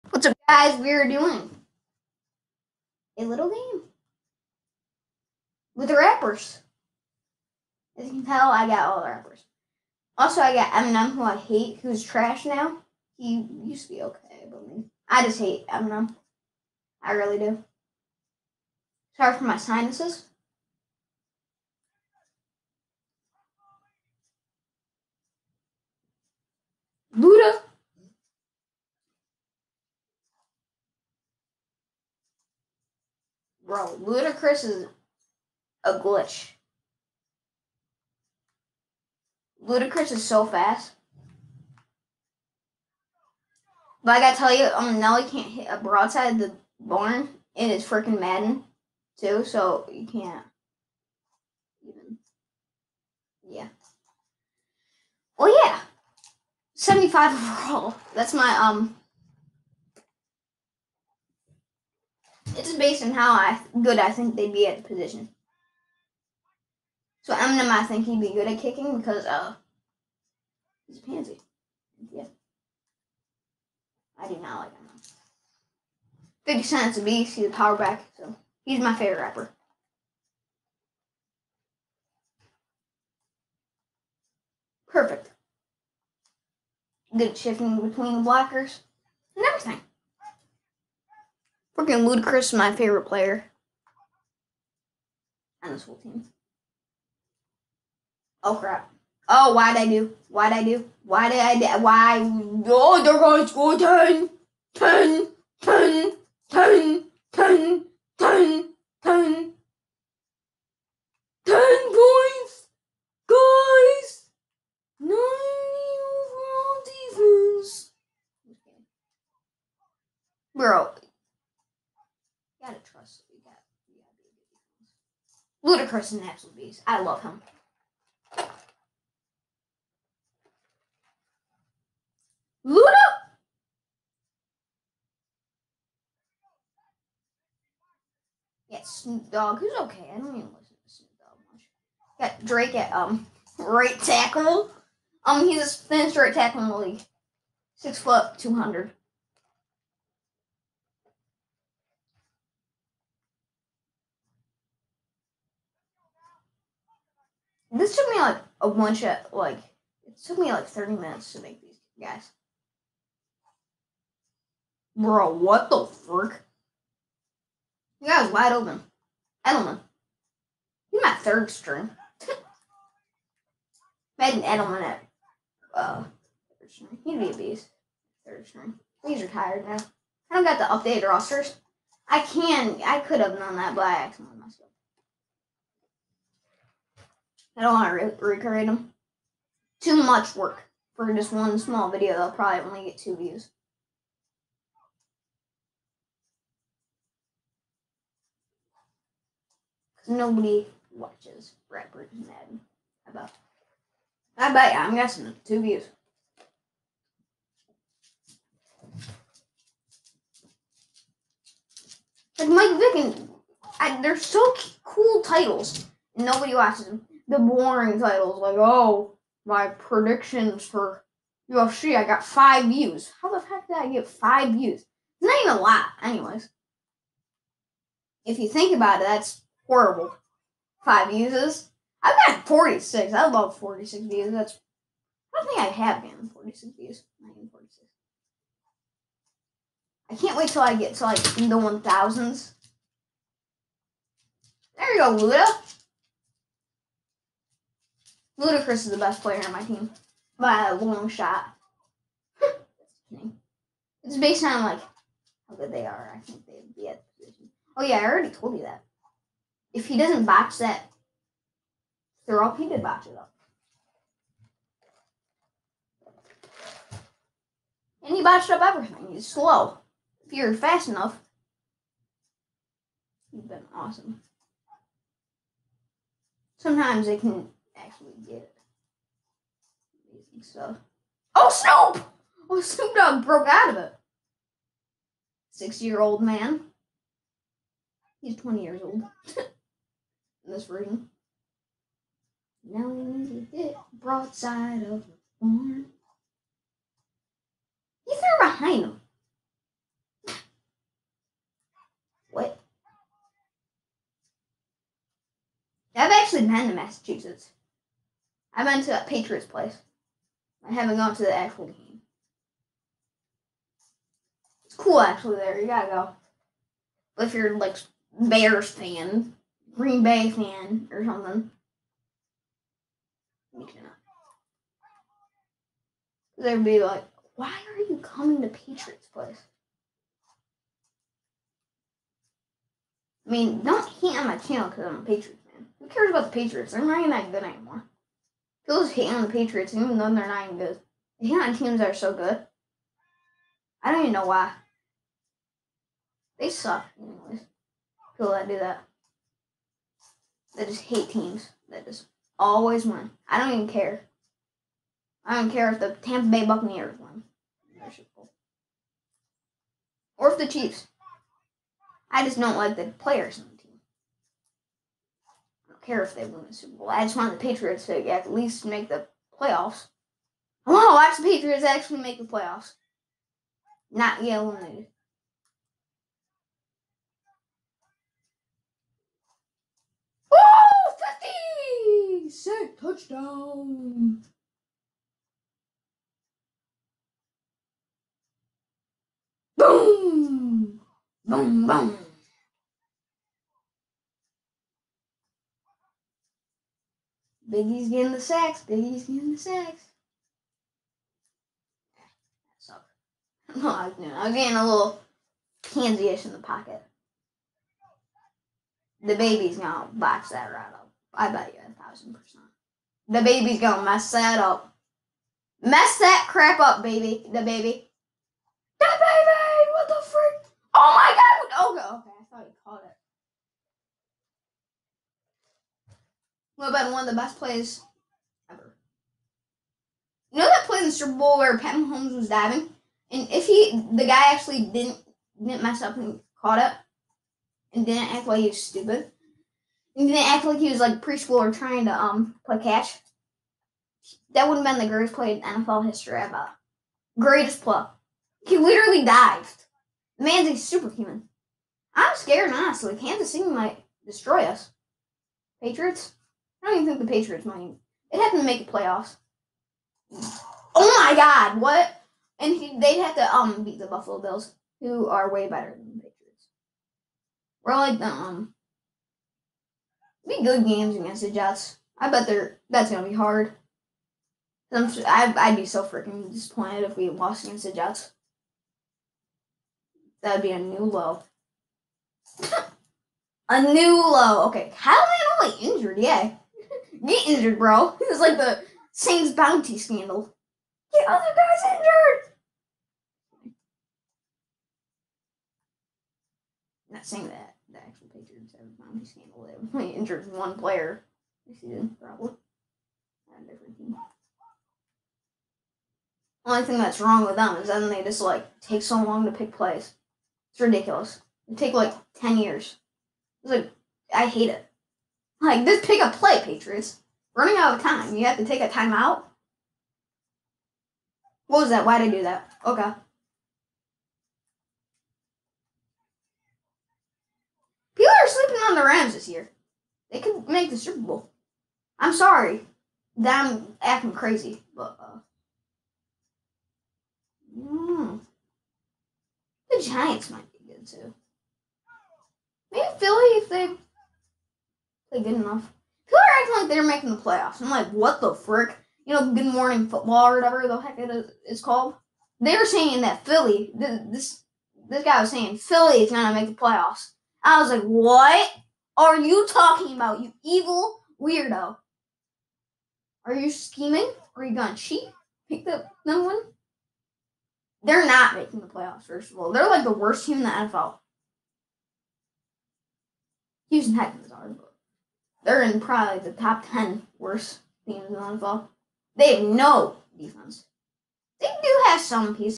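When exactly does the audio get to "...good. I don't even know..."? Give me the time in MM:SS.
05:42.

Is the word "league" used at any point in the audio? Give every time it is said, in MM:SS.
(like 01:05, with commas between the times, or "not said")
02:26.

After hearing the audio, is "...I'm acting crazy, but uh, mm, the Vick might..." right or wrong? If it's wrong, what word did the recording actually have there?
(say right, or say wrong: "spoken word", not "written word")
wrong: "Giants", not "Vick".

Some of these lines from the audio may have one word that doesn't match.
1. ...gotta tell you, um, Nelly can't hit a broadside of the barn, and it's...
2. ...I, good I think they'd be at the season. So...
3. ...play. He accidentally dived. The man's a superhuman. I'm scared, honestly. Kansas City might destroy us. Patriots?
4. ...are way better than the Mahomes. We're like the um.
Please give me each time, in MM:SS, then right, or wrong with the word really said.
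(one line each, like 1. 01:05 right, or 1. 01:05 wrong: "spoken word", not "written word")
1. 00:44 right
2. 01:03 wrong: "position", not "season"
3. 07:27 wrong: "literally", not "accidentally"
4. 07:45 wrong: "Patriots", not "Mahomes".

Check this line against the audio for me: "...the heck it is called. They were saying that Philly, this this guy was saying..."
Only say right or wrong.
right.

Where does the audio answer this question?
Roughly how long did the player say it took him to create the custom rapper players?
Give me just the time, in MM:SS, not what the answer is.
02:40.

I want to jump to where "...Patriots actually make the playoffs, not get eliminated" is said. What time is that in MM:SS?
06:11.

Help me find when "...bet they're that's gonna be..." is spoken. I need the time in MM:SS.
07:52.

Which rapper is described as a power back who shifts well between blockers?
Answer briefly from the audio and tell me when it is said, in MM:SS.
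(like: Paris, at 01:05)
50 Cent, at 01:16.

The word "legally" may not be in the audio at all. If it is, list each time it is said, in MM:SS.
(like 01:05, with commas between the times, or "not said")
not said.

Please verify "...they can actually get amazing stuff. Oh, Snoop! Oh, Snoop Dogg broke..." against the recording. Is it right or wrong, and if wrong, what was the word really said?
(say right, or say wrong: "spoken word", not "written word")
right.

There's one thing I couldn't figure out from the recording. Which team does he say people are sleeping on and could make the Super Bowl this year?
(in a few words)
Rams.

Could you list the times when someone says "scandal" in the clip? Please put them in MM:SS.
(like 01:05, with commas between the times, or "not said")
08:09, 08:19.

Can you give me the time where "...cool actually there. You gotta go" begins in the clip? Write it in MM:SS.
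05:14.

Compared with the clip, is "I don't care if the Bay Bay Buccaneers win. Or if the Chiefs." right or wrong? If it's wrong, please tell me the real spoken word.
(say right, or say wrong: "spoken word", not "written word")
wrong: "Tampa", not "Bay".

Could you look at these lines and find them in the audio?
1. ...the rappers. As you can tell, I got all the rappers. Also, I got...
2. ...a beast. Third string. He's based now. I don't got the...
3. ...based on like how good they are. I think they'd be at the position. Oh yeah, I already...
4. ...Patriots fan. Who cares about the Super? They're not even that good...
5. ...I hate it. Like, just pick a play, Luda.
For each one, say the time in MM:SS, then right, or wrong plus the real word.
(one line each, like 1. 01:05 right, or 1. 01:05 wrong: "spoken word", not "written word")
1. 00:05 right
2. 02:57 wrong: "retired", not "based"
3. 04:14 right
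4. 05:35 wrong: "Patriots", not "Super"
5. 08:34 wrong: "Patriots", not "Luda".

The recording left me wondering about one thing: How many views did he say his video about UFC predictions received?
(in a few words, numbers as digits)
5.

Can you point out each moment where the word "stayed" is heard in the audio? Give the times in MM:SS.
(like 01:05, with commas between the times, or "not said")
not said.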